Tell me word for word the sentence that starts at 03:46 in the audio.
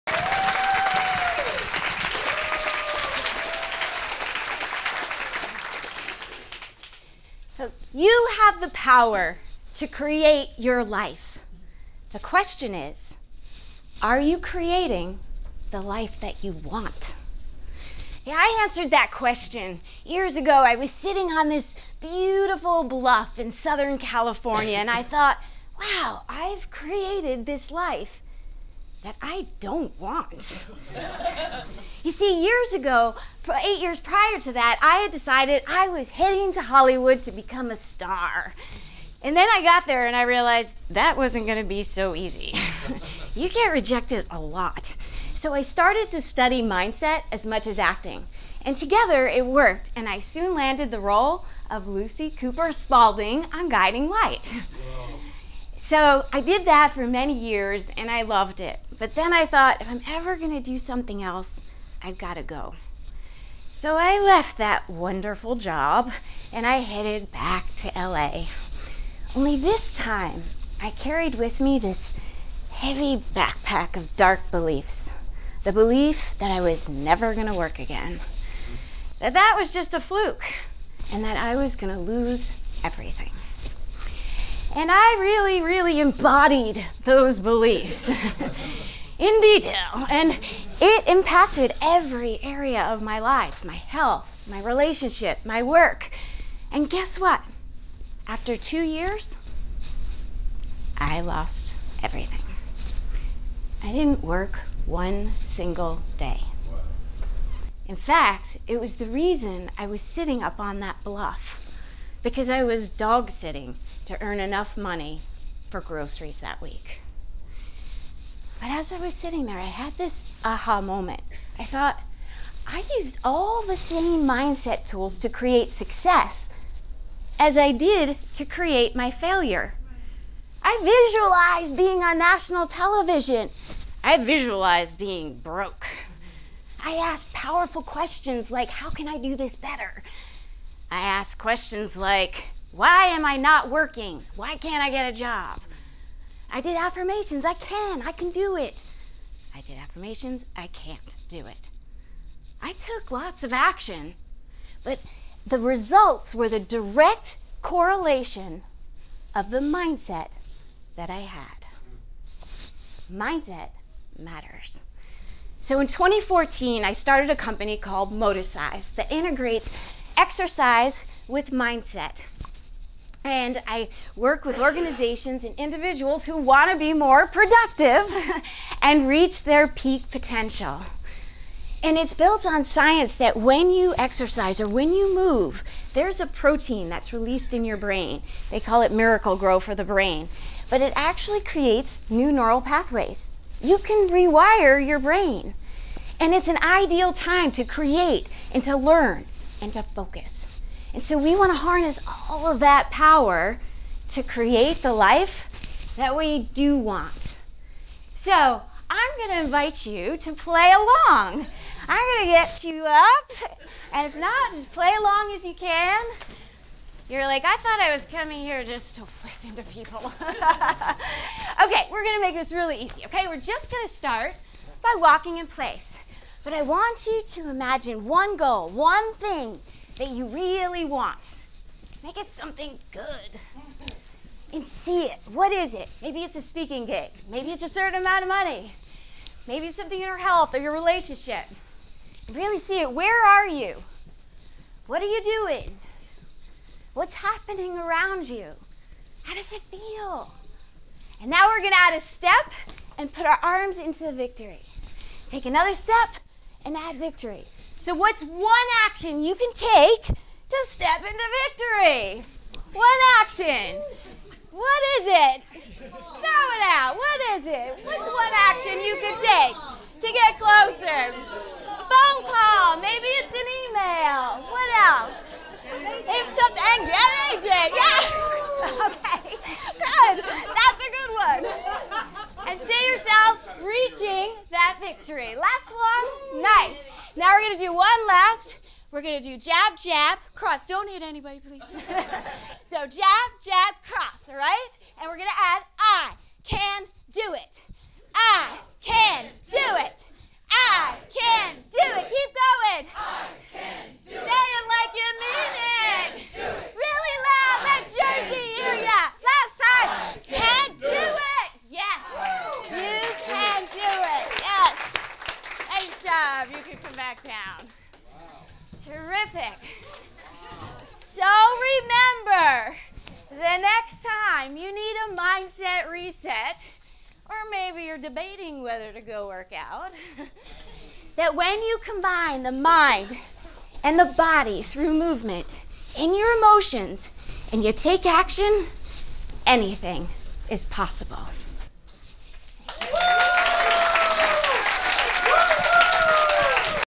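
But I want you to imagine one goal, one thing that you really want.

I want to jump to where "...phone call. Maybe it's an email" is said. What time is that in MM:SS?
04:31.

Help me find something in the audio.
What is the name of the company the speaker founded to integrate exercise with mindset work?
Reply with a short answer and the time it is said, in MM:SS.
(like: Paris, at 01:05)
Moticise, at 02:48.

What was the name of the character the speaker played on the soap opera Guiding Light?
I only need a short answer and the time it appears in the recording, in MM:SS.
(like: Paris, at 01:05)
Lucy Cooper Spaulding, at 00:51.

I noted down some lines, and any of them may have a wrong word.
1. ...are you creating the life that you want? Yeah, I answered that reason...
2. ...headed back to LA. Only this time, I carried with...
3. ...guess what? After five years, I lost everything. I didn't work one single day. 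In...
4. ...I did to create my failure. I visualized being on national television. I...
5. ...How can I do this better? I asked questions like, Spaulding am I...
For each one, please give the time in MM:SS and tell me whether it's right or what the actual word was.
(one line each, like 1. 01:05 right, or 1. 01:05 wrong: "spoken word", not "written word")
1. 00:14 wrong: "question", not "reason"
2. 01:06 right
3. 01:36 wrong: "two", not "five"
4. 02:07 right
5. 02:18 wrong: "Why", not "Spaulding".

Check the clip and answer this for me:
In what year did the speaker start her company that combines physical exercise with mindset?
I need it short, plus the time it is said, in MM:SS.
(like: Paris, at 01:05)
2014, at 02:45.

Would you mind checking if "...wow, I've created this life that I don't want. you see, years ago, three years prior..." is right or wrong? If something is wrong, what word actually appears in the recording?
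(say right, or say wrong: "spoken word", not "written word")
wrong: "eight", not "three".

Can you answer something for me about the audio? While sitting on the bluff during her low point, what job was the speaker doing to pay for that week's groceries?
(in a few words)
Dog sitting.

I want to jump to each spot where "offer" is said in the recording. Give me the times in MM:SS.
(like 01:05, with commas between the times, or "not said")
not said.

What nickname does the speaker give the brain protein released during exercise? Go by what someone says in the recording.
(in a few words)
Miracle grow for the brain.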